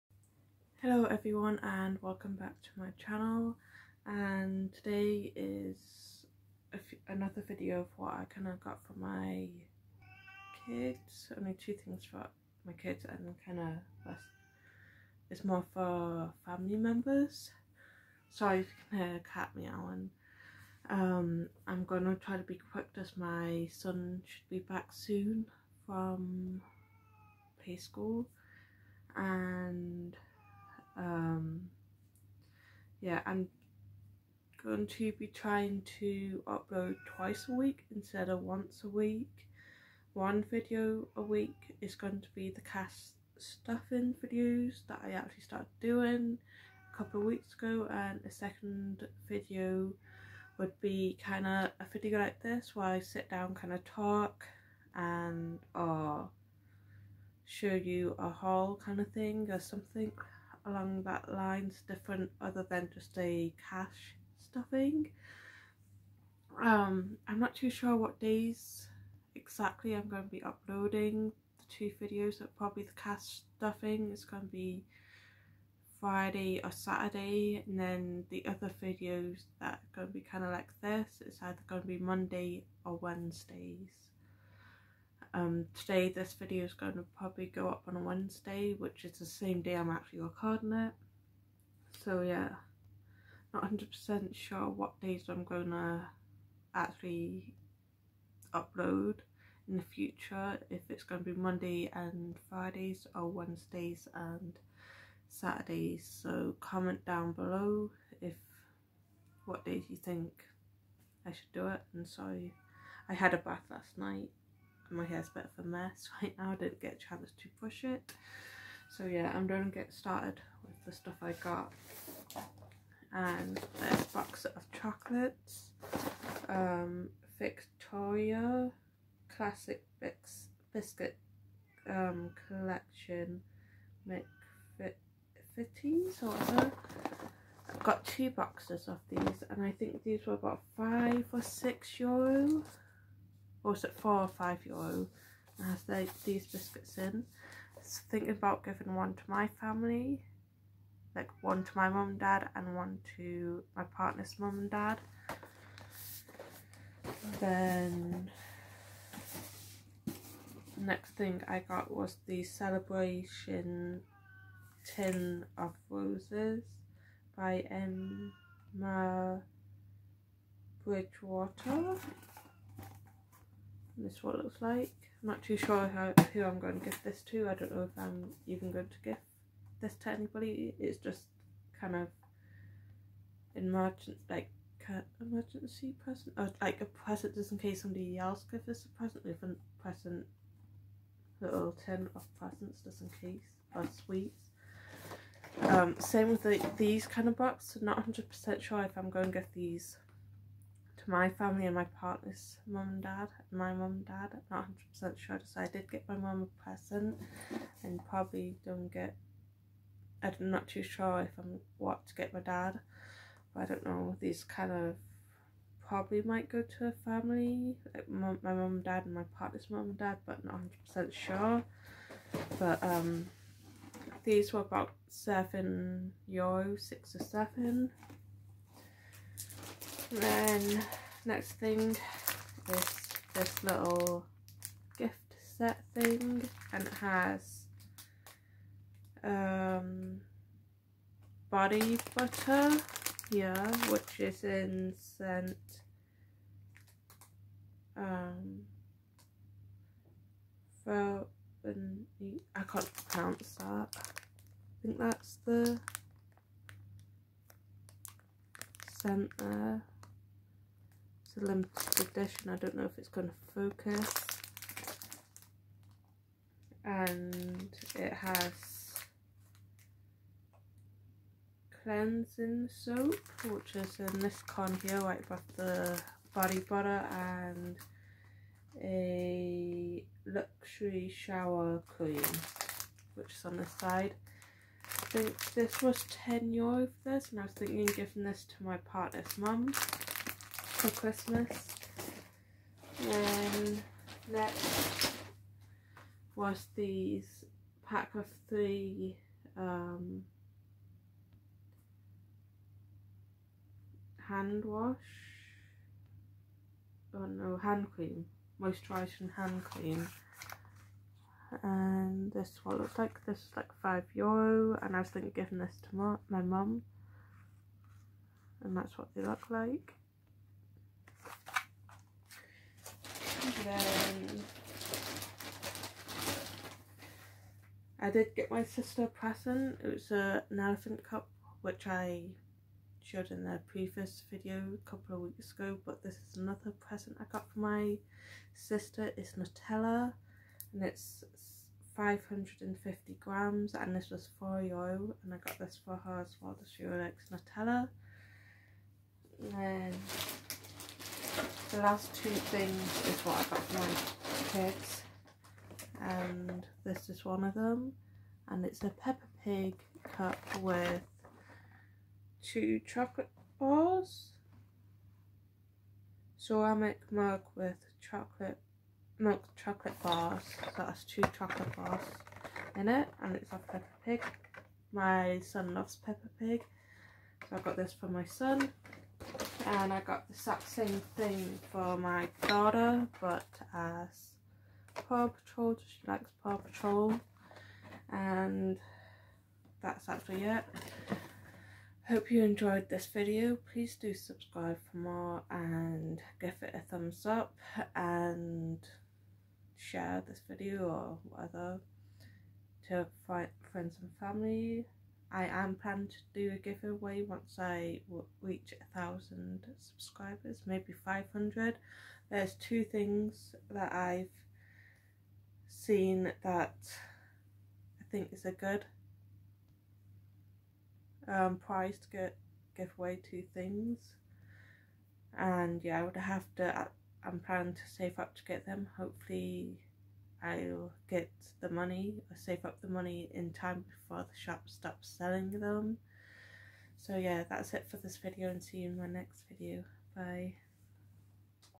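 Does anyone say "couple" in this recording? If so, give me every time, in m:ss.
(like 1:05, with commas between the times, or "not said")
0:46, 5:34.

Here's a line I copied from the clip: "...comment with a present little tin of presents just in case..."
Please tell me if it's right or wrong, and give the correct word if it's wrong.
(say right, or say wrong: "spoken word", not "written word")
wrong: "present", not "comment".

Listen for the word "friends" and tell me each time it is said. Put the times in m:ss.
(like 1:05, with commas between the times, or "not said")
6:43.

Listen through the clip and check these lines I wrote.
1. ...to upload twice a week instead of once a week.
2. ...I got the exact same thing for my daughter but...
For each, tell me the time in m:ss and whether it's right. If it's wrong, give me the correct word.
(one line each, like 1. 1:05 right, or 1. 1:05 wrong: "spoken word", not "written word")
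1. 0:35 right
2. 6:19 right.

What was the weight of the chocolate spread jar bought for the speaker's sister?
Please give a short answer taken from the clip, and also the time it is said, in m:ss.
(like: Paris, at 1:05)
550 grams, at 5:41.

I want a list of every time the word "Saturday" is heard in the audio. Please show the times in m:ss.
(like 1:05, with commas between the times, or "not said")
1:16, 1:45.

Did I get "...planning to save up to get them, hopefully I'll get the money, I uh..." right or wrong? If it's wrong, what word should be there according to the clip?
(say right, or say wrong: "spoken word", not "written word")
right.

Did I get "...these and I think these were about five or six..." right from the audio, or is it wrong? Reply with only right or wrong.
right.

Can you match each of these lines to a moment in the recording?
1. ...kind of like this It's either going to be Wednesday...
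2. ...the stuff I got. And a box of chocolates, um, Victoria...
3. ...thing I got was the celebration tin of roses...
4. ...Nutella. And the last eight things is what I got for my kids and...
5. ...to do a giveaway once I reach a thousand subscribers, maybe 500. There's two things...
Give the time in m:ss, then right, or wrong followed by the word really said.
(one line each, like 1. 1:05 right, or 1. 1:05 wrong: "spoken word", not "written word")
1. 1:20 wrong: "Monday", not "Wednesday"
2. 2:00 right
3. 2:41 right
4. 5:47 wrong: "two", not "eight"
5. 6:46 right.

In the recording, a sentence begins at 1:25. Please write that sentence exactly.
Um, today this video is going to probably go up on a Wednesday, which is the same day I'm actually recording it.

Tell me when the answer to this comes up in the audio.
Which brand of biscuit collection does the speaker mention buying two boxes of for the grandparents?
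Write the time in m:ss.
2:14.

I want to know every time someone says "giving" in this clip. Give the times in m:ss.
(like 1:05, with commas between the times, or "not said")
2:28, 4:47, 5:15.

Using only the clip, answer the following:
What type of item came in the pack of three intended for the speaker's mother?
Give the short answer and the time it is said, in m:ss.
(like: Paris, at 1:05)
Moisturising hand cream, at 5:08.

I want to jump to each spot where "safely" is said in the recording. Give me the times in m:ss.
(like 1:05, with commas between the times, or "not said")
not said.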